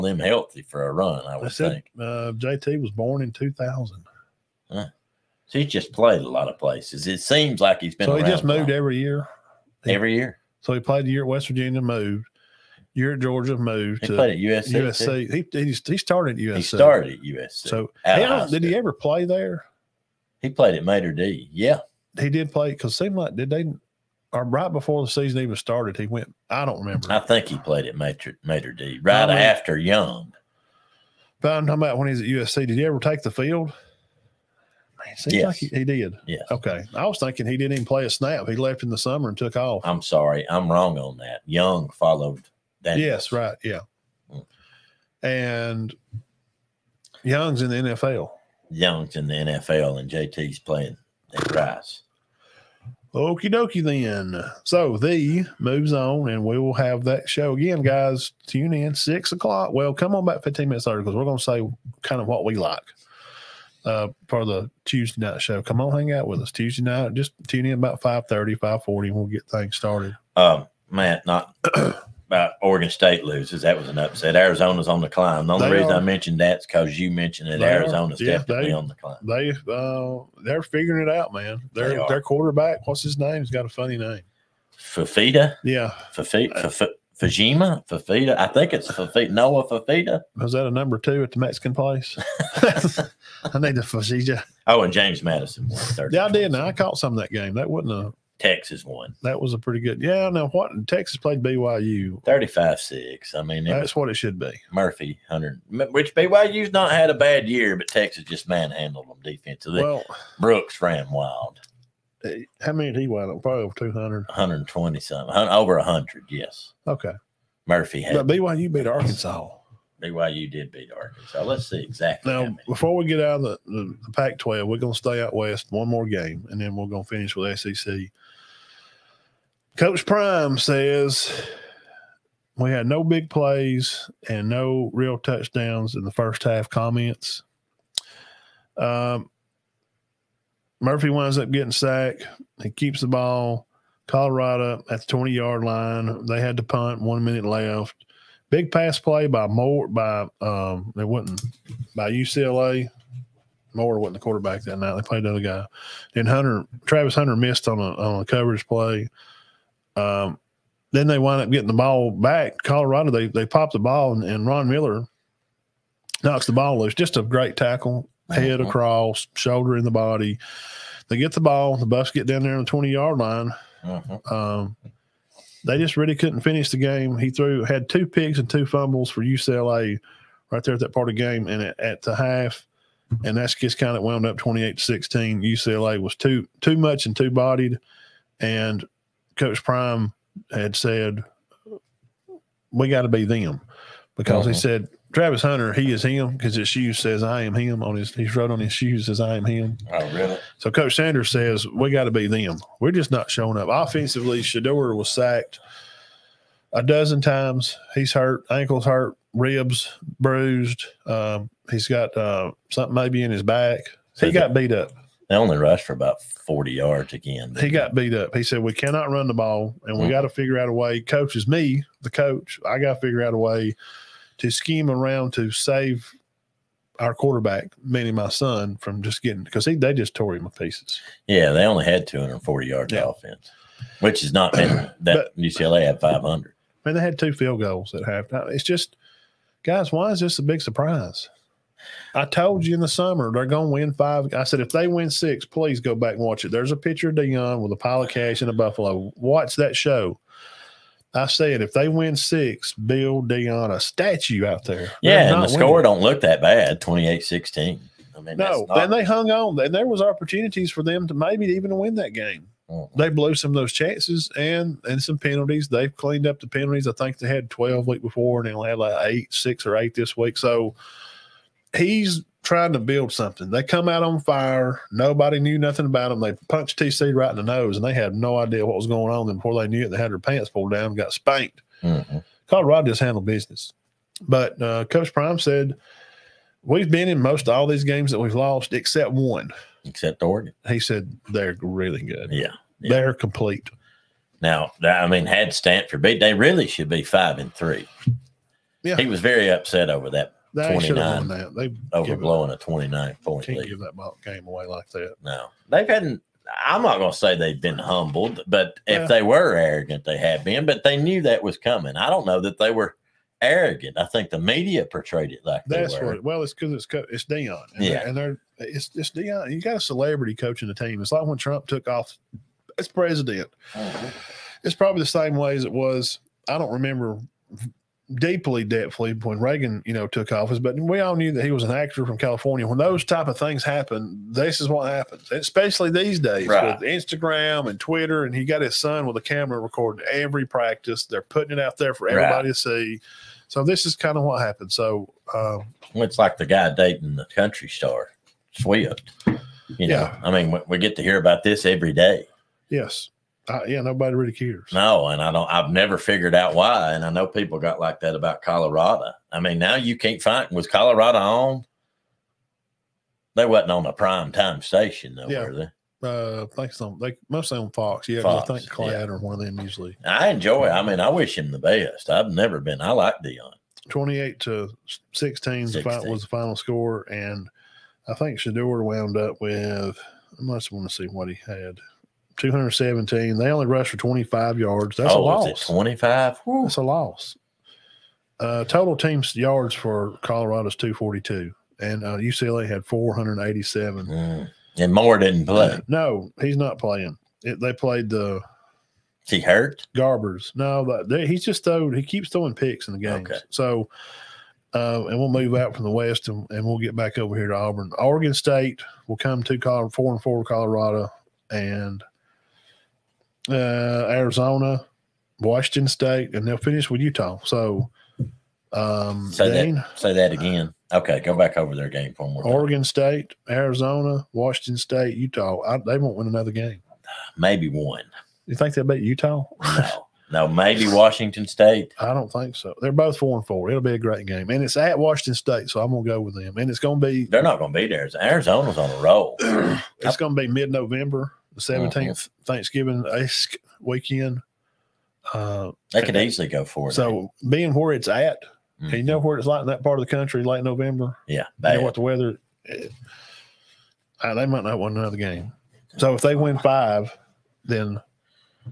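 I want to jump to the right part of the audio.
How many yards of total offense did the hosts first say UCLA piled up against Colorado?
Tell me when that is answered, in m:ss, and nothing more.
3:56.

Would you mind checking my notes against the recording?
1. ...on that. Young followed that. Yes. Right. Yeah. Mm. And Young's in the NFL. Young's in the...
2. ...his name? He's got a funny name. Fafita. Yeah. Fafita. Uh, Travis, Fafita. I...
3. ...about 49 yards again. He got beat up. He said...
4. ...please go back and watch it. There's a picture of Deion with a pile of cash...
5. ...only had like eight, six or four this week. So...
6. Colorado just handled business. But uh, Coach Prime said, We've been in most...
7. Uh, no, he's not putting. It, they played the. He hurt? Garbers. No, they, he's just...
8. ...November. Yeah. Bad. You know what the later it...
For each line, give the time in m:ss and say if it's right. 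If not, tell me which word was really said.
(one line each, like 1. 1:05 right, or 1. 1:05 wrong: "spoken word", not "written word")
1. 0:40 right
2. 1:23 wrong: "Fajima", not "Travis"
3. 3:35 wrong: "40", not "49"
4. 4:05 right
5. 4:28 wrong: "eight", not "four"
6. 4:42 right
7. 6:35 wrong: "playing", not "putting"
8. 7:30 wrong: "weather", not "later".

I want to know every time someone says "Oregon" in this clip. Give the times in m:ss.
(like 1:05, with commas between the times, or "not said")
1:12, 4:50, 6:47, 7:02.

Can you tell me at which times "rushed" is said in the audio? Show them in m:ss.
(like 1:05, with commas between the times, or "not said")
3:35, 6:23.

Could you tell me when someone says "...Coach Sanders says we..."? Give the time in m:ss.
3:20.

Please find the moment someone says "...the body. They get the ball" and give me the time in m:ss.
2:49.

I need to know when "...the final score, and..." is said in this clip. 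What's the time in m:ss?
6:16.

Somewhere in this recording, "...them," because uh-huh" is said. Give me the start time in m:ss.
3:13.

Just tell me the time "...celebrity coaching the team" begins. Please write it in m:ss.
5:19.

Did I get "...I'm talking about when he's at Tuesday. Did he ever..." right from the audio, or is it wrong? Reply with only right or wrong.
wrong.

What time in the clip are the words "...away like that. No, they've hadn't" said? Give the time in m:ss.
5:04.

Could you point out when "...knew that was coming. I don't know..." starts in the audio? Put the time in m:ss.
5:10.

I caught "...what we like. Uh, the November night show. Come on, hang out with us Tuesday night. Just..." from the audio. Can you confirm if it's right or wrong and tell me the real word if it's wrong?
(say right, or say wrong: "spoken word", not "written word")
wrong: "Tuesday", not "November".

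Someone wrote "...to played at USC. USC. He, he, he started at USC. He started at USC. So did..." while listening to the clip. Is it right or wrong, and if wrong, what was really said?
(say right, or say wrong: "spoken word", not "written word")
right.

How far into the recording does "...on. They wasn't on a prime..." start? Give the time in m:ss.
6:01.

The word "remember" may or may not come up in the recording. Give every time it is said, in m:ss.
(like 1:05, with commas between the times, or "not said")
0:26, 5:26.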